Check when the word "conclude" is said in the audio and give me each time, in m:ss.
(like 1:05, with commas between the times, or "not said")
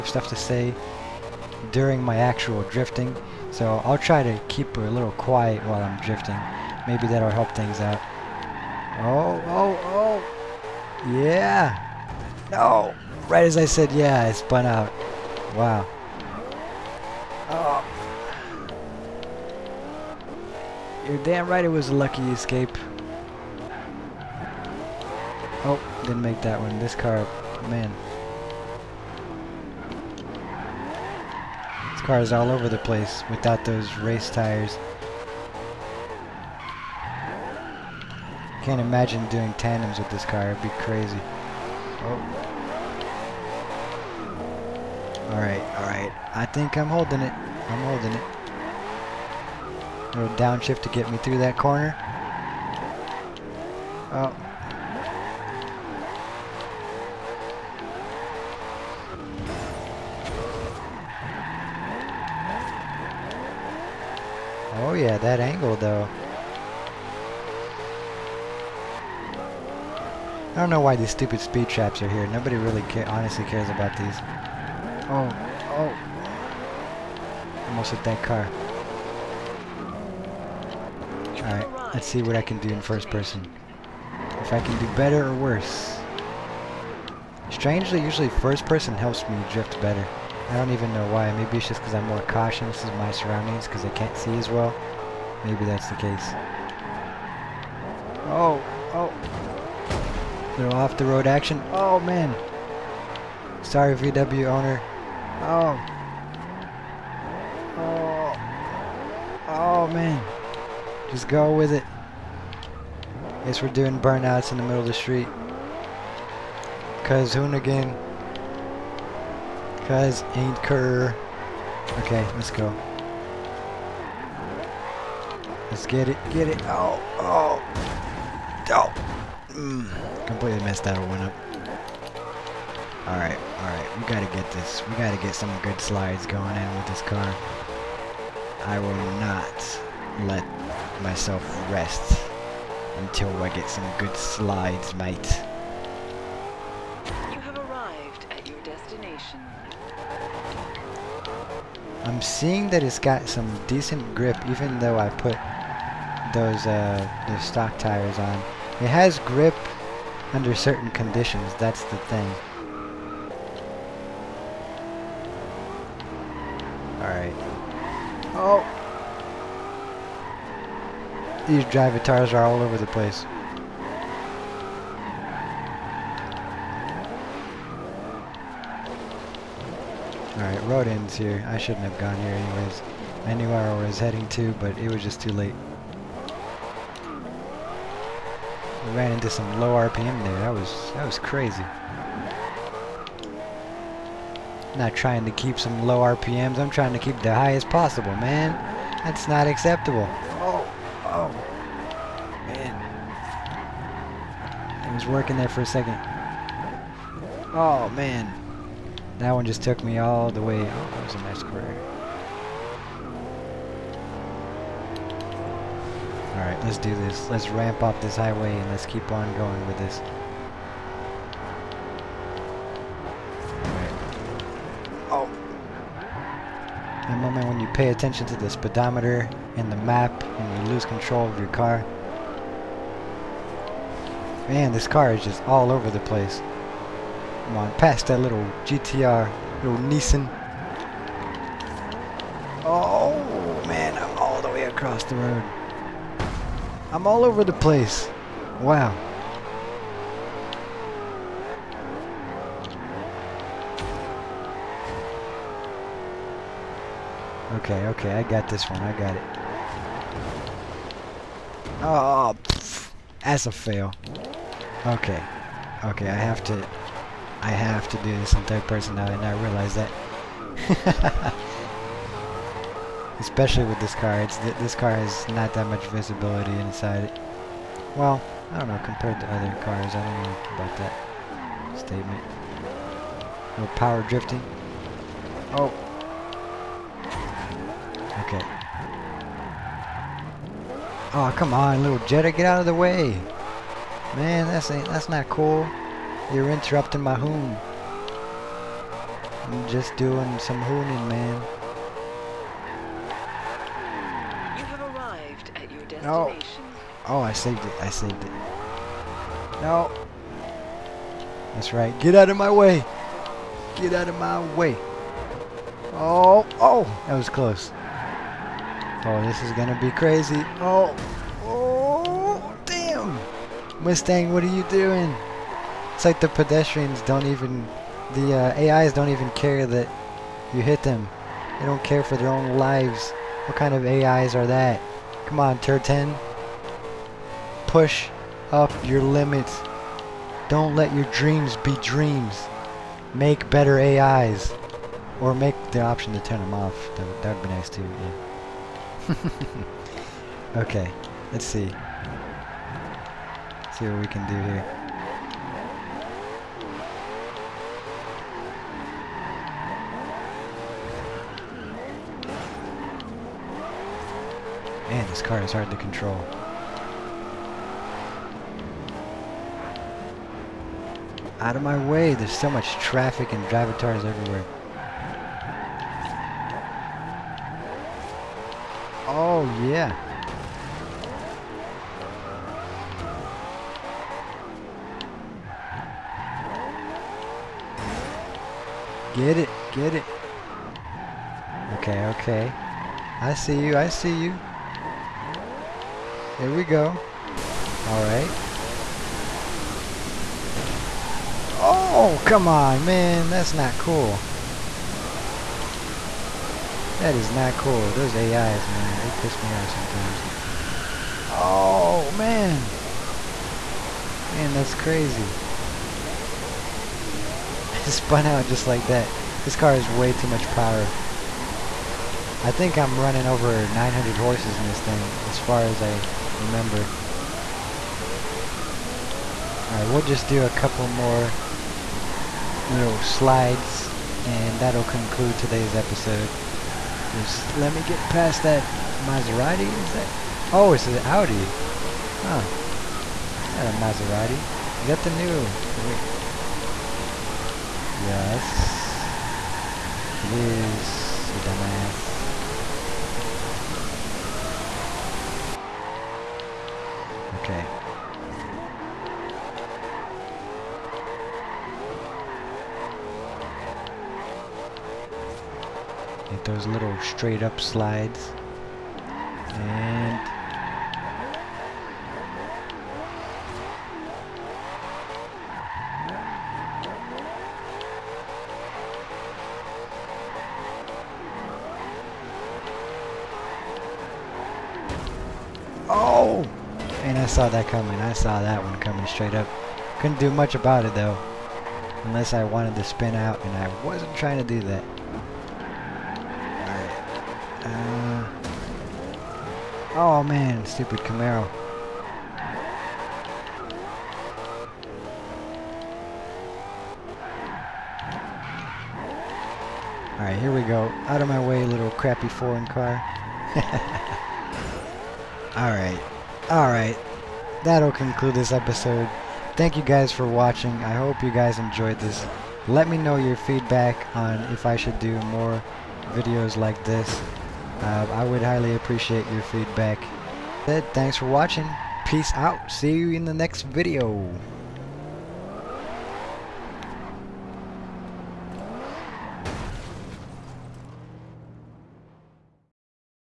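7:14, 8:37.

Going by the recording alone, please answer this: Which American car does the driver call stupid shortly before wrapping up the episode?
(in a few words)
Camaro.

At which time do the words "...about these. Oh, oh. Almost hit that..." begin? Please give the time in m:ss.
1:13.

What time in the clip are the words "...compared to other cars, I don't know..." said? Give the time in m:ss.
4:38.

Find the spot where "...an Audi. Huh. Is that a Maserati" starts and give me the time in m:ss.
7:20.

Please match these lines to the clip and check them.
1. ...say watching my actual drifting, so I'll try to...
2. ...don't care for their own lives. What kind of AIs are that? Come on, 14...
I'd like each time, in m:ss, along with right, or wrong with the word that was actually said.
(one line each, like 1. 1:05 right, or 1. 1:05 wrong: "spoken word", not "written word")
1. 0:00 wrong: "during", not "watching"
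2. 5:31 wrong: "10", not "14".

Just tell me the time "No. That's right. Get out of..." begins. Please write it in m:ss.
5:09.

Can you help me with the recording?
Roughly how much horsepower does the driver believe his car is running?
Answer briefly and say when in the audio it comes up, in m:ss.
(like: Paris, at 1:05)
Over 900, at 7:03.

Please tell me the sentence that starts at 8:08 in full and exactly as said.
I saw that one coming straight up.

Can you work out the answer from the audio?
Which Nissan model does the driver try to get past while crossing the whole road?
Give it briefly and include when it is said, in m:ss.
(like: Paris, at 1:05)
GTR, at 3:58.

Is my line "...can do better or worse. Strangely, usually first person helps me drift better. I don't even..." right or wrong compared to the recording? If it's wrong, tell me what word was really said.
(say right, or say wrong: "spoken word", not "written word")
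right.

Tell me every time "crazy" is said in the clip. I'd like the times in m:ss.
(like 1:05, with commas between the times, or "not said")
0:40, 3:11, 5:19, 6:54.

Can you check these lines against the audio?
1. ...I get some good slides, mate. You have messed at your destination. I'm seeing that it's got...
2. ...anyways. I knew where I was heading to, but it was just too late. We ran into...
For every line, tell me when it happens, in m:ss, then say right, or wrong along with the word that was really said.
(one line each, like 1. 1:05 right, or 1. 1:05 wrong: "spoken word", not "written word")
1. 2:23 wrong: "arrived", not "messed"
2. 3:02 right.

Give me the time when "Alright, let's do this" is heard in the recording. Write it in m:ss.
3:36.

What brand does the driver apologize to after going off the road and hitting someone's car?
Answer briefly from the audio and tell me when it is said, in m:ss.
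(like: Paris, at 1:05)
VW, at 1:43.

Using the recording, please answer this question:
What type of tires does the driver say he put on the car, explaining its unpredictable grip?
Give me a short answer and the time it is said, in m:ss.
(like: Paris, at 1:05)
Stock tires, at 2:37.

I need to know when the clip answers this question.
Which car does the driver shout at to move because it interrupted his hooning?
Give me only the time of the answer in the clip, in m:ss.
4:51.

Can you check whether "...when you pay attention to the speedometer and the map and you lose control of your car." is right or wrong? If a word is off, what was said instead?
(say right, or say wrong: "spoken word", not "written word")
right.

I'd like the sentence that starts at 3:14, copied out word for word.
not trying to keep some low RPMs.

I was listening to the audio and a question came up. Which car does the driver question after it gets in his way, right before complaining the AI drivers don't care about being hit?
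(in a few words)
Mustang.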